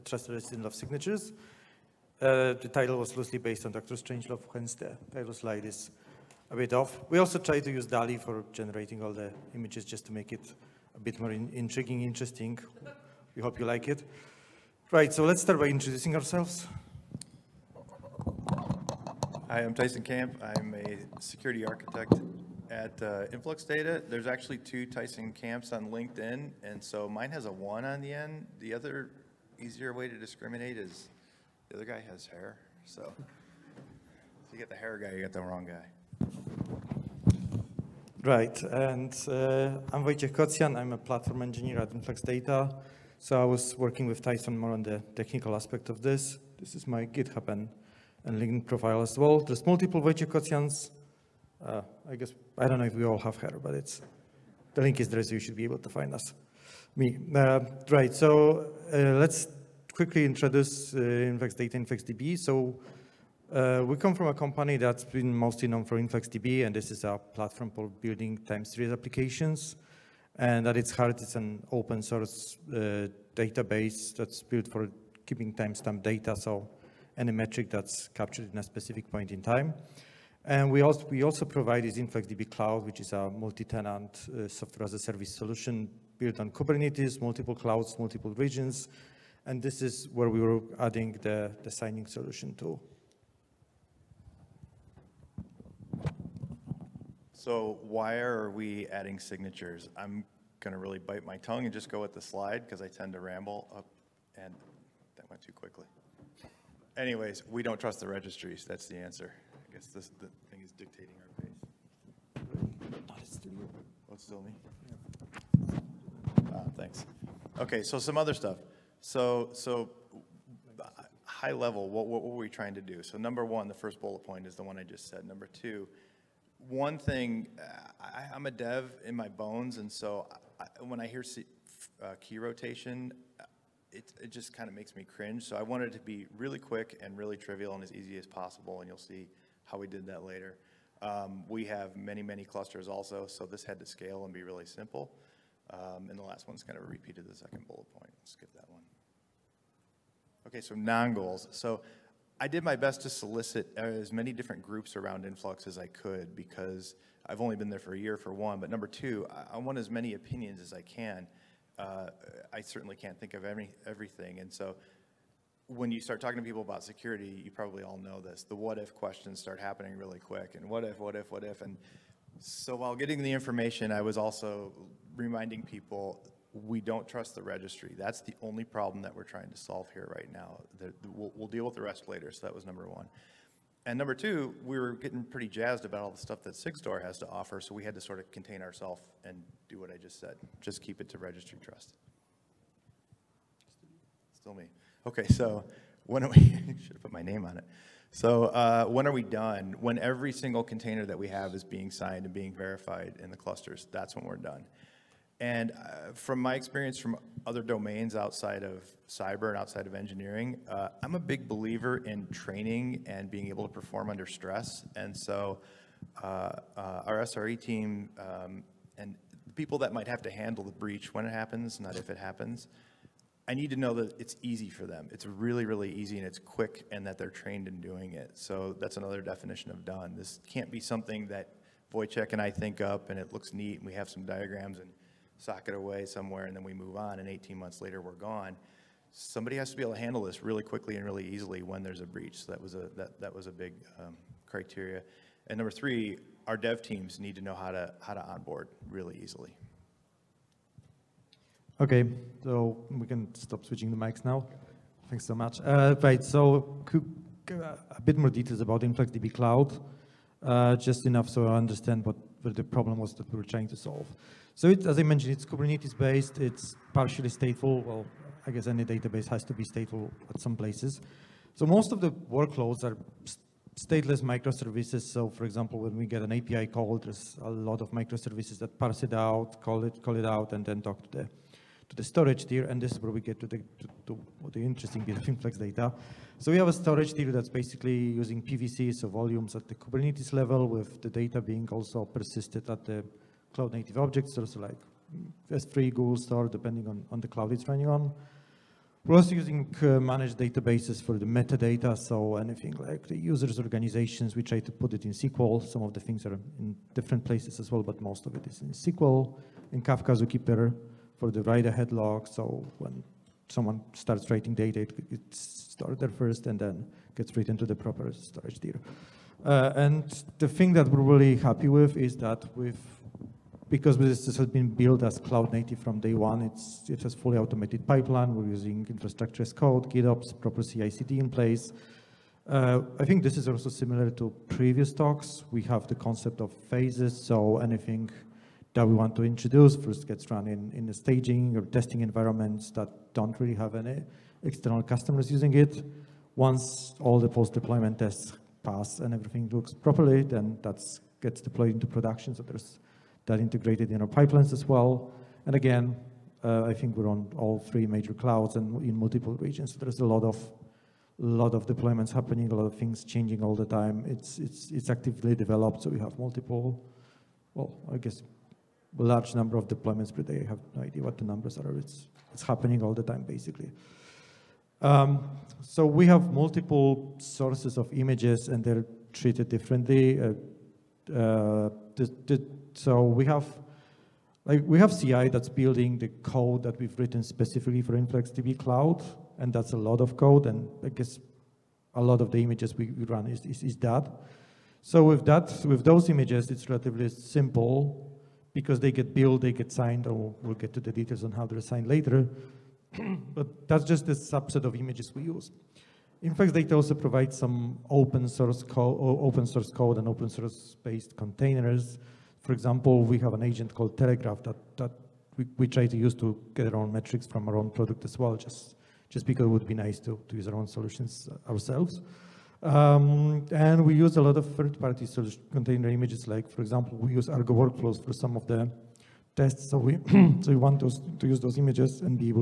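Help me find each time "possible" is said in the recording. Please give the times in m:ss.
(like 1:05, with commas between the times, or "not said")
2:18.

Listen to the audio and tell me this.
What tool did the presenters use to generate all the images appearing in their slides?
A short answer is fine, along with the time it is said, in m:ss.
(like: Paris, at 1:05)
DALL-E, at 0:07.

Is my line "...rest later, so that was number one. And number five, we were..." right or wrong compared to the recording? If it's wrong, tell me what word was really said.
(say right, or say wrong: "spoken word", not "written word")
wrong: "two", not "five".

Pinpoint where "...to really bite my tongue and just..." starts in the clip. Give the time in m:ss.
1:40.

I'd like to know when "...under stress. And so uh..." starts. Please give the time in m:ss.
3:34.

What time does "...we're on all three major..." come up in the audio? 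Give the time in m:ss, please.
5:56.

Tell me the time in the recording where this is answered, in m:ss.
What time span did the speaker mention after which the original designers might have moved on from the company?
3:57.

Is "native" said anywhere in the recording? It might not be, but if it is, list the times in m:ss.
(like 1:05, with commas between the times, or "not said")
4:53, 5:25.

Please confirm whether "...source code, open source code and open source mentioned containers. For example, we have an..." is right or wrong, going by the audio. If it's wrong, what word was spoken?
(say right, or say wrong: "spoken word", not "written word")
wrong: "based", not "mentioned".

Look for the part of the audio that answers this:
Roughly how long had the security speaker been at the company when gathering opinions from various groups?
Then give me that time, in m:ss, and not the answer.
2:37.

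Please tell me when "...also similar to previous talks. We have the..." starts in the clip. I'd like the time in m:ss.
5:33.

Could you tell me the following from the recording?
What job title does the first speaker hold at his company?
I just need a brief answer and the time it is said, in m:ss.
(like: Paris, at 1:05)
Security architect, at 0:21.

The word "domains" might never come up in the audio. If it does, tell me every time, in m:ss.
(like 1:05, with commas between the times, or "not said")
3:27.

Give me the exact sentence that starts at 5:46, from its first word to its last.
Once all the post-deployment tests pass and everything looks properly, then that gets deployed into production.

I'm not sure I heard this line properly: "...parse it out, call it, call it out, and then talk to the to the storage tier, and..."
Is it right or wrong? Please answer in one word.
right.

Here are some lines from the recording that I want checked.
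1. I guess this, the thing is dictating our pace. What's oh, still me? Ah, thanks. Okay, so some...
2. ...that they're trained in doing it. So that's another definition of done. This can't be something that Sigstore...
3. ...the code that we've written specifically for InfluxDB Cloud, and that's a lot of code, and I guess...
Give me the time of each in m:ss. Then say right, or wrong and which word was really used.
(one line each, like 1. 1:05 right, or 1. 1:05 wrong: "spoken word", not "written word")
1. 1:49 right
2. 3:47 wrong: "Wojciech", not "Sigstore"
3. 6:25 right.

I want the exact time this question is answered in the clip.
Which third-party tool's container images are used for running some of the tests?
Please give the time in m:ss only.
7:07.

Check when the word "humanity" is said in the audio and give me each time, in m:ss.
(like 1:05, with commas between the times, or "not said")
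not said.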